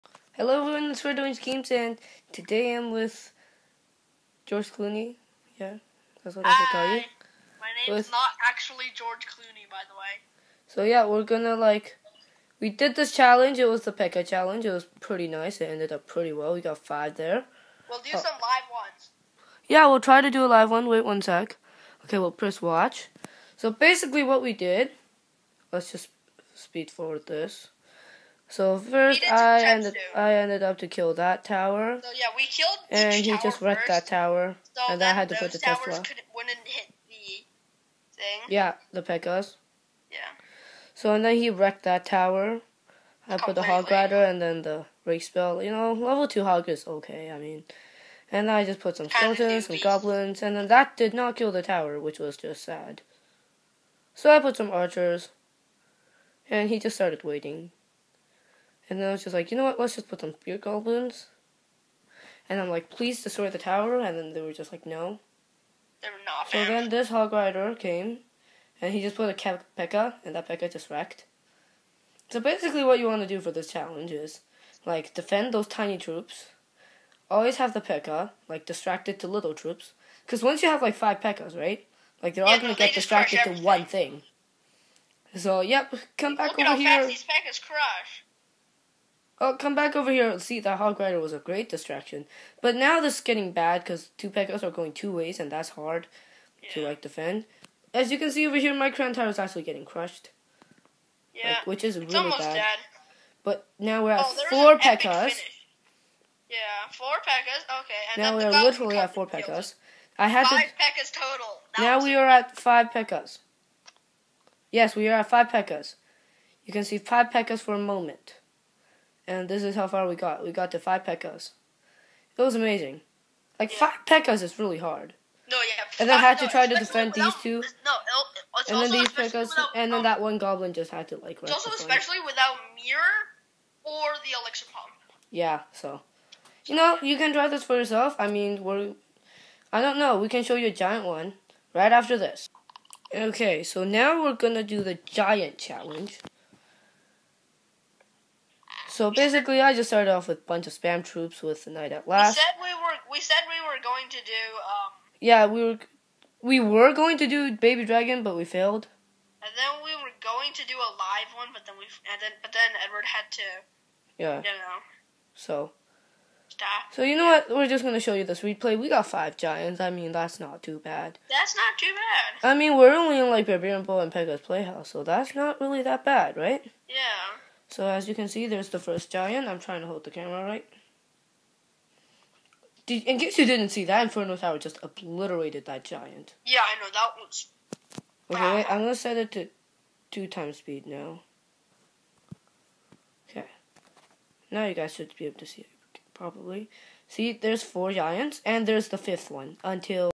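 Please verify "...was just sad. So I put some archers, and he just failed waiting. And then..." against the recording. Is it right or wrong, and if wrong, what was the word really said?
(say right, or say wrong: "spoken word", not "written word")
wrong: "started", not "failed".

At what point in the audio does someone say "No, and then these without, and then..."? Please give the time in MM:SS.
02:07.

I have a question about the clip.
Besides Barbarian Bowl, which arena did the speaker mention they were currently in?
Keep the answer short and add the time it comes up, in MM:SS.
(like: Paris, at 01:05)
Pekka's Playhouse, at 02:54.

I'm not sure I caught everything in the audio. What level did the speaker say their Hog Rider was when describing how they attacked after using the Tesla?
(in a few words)
2.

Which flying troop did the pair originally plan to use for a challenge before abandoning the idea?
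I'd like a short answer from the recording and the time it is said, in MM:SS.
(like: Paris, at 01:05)
Baby Dragon, at 02:37.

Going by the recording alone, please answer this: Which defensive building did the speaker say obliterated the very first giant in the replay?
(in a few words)
Inferno Tower.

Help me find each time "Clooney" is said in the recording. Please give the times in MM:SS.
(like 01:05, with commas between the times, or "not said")
00:04, 00:09.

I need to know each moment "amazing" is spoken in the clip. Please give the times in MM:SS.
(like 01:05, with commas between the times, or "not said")
02:02.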